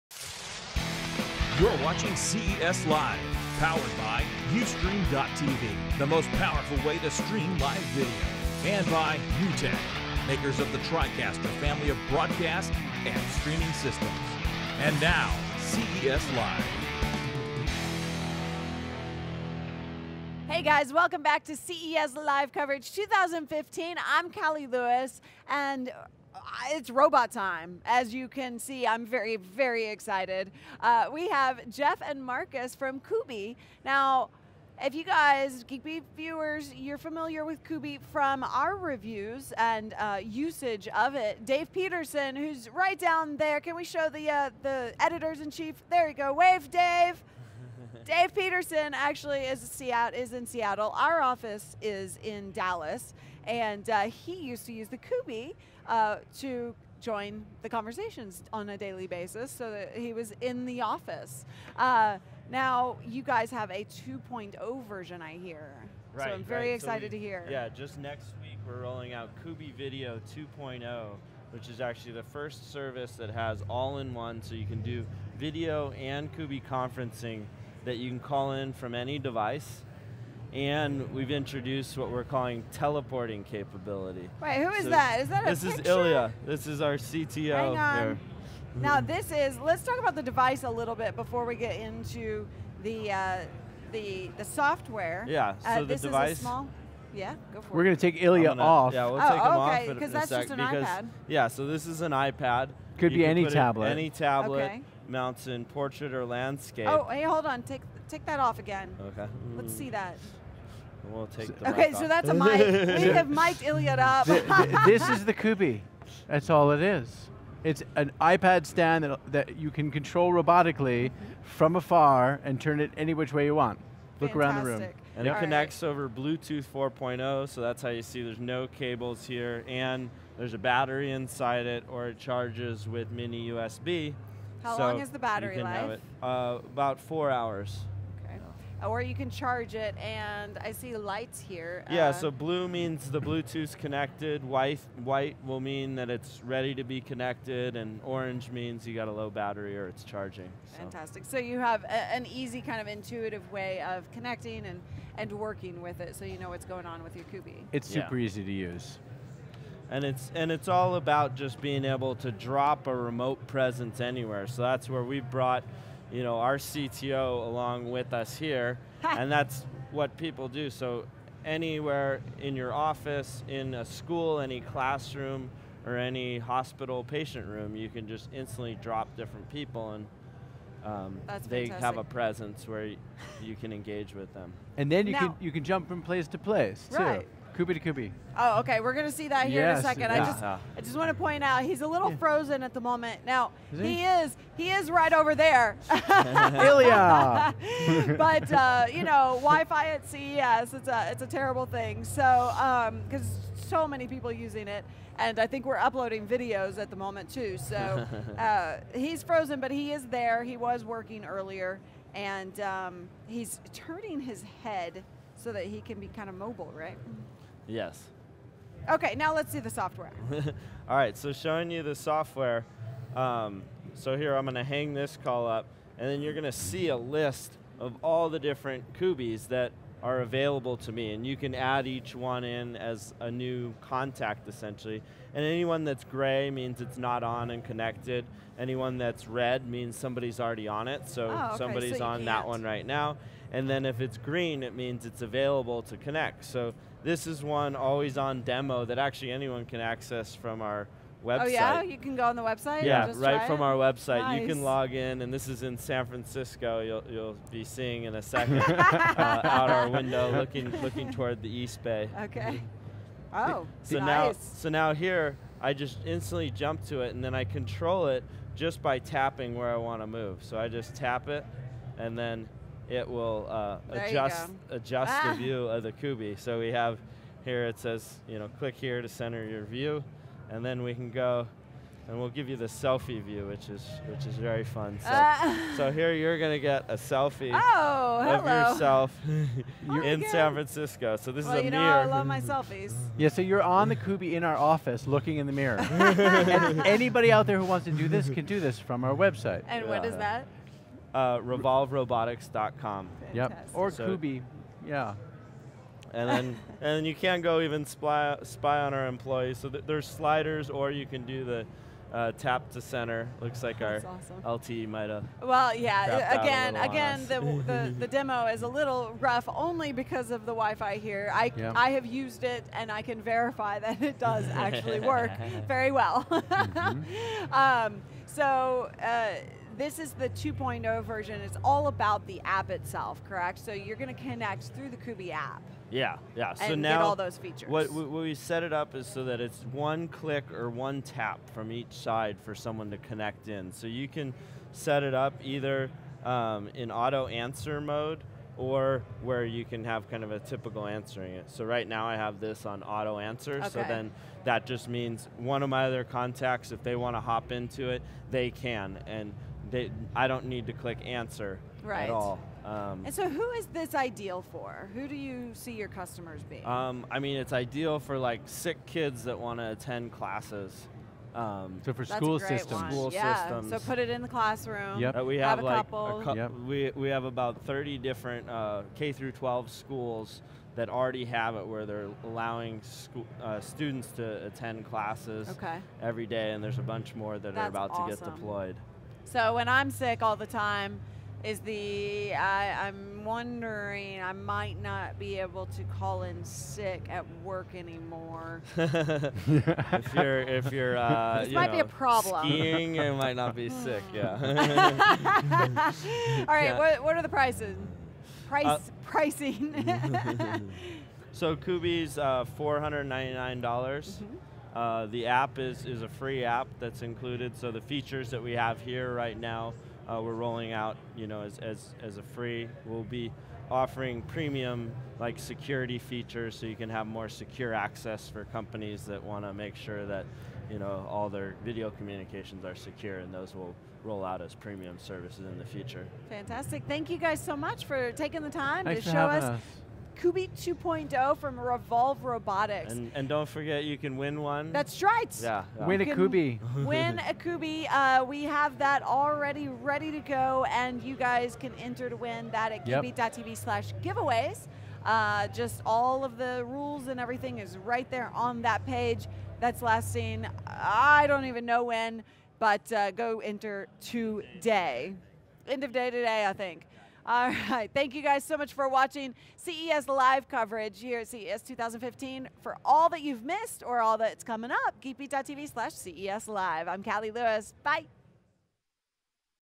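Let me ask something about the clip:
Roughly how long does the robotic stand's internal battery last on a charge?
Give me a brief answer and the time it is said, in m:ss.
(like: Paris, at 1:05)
4 hours, at 2:17.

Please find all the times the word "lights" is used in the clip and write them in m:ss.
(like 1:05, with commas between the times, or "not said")
2:20.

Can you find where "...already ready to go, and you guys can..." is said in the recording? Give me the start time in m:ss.
7:29.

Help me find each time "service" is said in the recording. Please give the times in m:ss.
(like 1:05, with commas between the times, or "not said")
1:12, 7:14.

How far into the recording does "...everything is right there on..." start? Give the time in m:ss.
7:37.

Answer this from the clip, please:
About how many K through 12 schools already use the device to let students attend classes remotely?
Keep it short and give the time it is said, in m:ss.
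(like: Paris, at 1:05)
30, at 6:17.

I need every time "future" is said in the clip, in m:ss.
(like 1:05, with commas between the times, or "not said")
7:15.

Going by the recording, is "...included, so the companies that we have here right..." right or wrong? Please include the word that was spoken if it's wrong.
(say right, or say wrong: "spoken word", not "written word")
wrong: "features", not "companies".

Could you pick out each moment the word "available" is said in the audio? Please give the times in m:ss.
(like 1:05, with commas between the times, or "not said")
3:50, 4:05.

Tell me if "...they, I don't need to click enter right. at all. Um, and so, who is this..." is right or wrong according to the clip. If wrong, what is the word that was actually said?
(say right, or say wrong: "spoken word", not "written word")
wrong: "answer", not "enter".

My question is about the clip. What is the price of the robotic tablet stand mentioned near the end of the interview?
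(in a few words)
$499.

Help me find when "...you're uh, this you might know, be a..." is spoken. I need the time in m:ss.
6:40.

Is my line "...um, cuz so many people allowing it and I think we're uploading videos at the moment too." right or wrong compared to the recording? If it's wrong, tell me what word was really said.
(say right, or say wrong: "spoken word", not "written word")
wrong: "using", not "allowing".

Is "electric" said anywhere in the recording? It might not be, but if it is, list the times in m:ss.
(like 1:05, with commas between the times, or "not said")
not said.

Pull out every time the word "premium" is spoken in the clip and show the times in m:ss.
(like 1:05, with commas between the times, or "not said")
7:04, 7:14.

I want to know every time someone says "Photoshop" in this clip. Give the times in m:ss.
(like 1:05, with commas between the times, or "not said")
not said.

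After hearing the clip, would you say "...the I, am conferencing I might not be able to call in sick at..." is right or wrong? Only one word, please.
wrong.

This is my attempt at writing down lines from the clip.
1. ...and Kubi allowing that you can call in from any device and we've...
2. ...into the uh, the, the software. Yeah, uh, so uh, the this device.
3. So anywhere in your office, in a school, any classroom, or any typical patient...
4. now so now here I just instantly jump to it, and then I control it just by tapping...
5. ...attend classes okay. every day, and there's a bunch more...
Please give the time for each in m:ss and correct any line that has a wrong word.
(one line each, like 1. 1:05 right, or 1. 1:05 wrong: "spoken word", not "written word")
1. 1:15 wrong: "conferencing", not "allowing"
2. 1:31 right
3. 2:50 wrong: "hospital", not "typical"
4. 4:24 right
5. 6:24 right.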